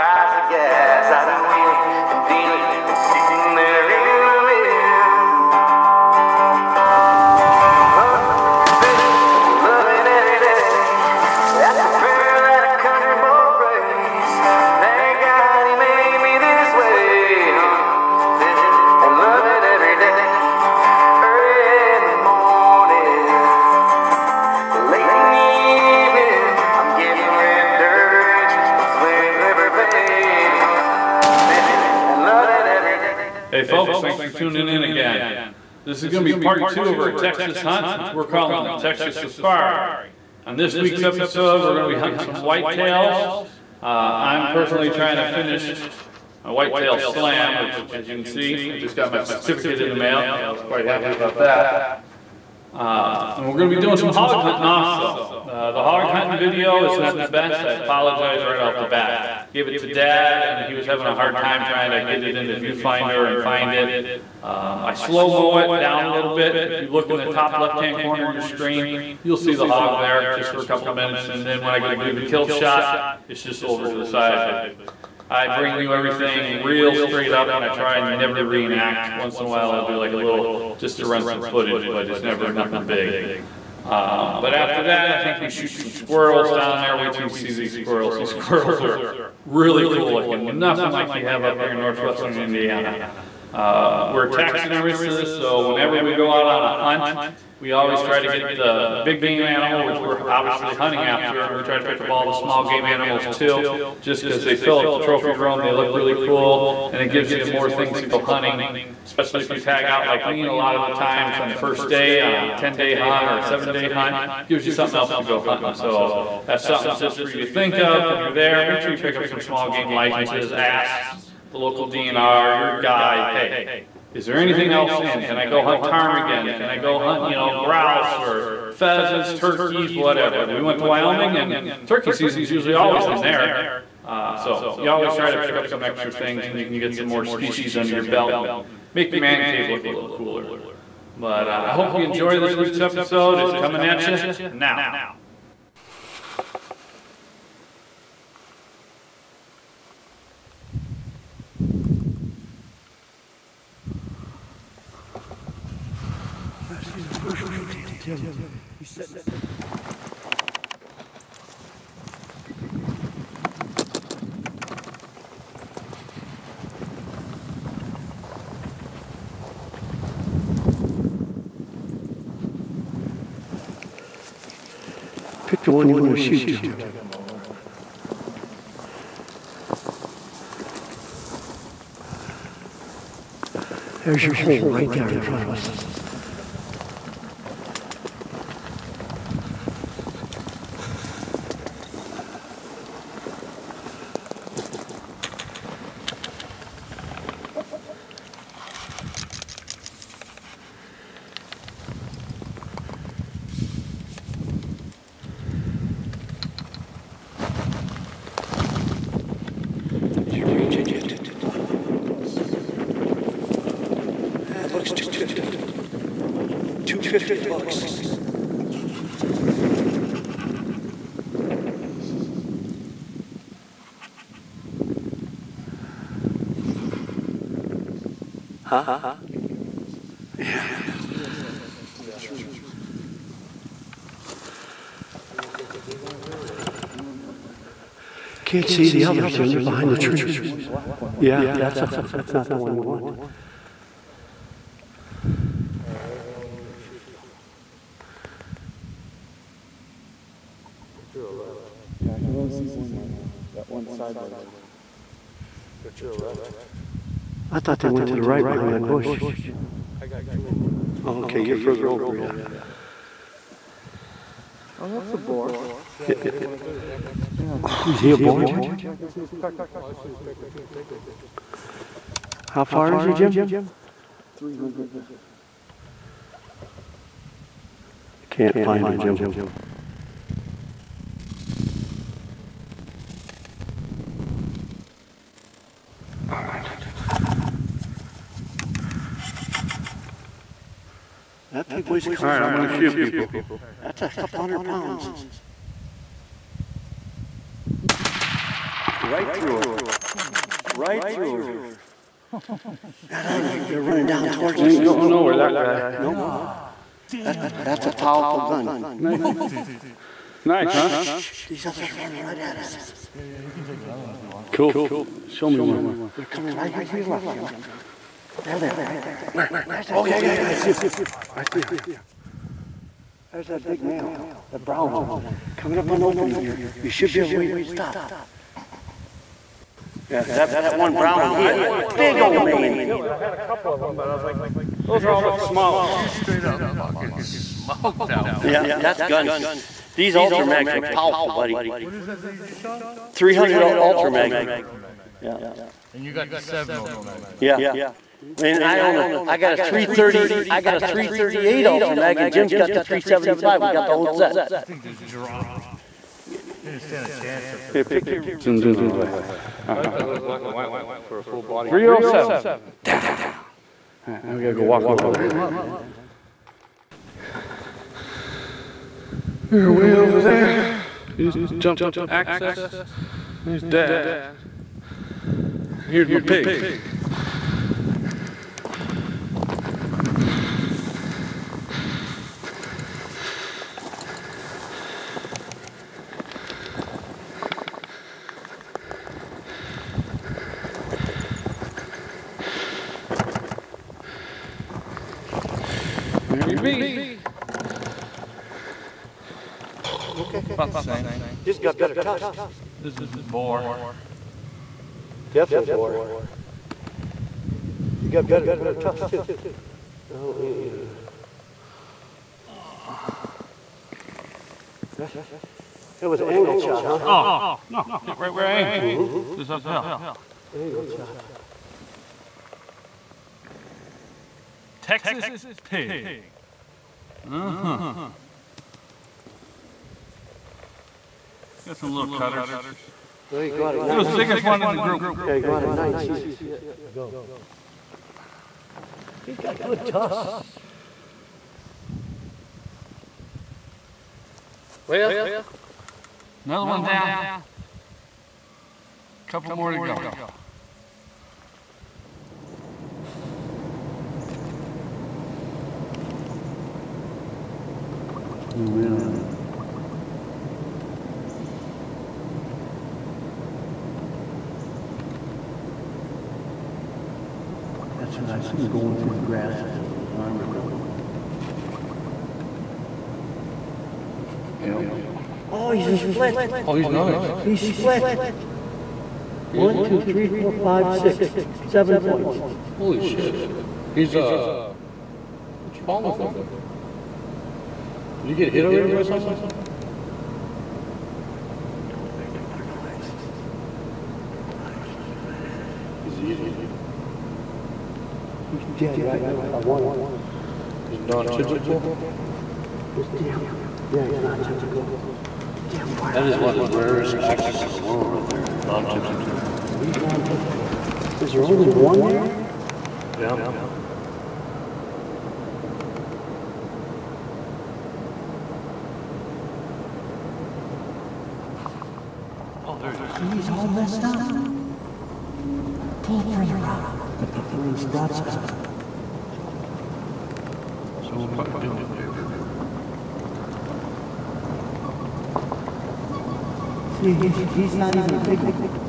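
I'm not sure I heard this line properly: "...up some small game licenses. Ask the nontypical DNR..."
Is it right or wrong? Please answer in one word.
wrong.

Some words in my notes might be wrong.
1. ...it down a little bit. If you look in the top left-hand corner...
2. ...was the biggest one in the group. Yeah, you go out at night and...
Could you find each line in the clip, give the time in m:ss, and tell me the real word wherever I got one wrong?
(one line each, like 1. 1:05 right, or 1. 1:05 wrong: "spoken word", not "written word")
1. 1:05 right
2. 7:13 right.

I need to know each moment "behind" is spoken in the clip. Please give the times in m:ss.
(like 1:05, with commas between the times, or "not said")
3:59, 4:18.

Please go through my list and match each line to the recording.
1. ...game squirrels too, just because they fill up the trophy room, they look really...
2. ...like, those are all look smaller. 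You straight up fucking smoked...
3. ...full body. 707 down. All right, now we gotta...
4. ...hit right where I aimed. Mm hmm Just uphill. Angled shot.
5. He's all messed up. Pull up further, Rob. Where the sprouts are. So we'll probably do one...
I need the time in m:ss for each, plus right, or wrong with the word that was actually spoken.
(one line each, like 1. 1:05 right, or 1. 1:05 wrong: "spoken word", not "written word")
1. 1:42 wrong: "animals", not "squirrels"
2. 5:34 right
3. 6:01 wrong: "307", not "707"
4. 6:58 right
5. 8:43 right.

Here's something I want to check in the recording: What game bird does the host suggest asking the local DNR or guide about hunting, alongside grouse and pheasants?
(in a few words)
Ptarmigan.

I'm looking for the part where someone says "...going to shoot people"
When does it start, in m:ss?
4:52.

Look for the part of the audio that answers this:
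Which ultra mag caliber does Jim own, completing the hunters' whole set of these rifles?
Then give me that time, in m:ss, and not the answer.
5:52.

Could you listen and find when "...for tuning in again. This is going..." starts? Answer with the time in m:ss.
0:34.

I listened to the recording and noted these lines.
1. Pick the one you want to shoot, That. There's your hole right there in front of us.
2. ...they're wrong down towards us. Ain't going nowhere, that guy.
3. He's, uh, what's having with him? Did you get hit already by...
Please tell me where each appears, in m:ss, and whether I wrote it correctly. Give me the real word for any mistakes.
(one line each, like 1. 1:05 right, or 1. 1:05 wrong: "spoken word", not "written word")
1. 2:55 wrong: "Jim", not "That"
2. 5:03 wrong: "running", not "wrong"
3. 8:03 wrong: "wrong", not "having".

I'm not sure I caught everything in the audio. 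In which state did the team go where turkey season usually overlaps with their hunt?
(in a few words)
Wyoming.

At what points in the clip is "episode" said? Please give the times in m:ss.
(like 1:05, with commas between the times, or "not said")
0:41, 2:22.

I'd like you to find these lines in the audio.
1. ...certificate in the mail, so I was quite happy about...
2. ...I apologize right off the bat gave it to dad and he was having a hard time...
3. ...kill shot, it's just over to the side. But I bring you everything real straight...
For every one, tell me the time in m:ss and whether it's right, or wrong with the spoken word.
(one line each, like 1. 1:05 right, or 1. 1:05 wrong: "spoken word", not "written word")
1. 0:49 right
2. 0:57 right
3. 1:12 right.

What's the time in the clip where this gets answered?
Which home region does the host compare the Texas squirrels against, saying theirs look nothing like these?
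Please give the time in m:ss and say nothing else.
1:31.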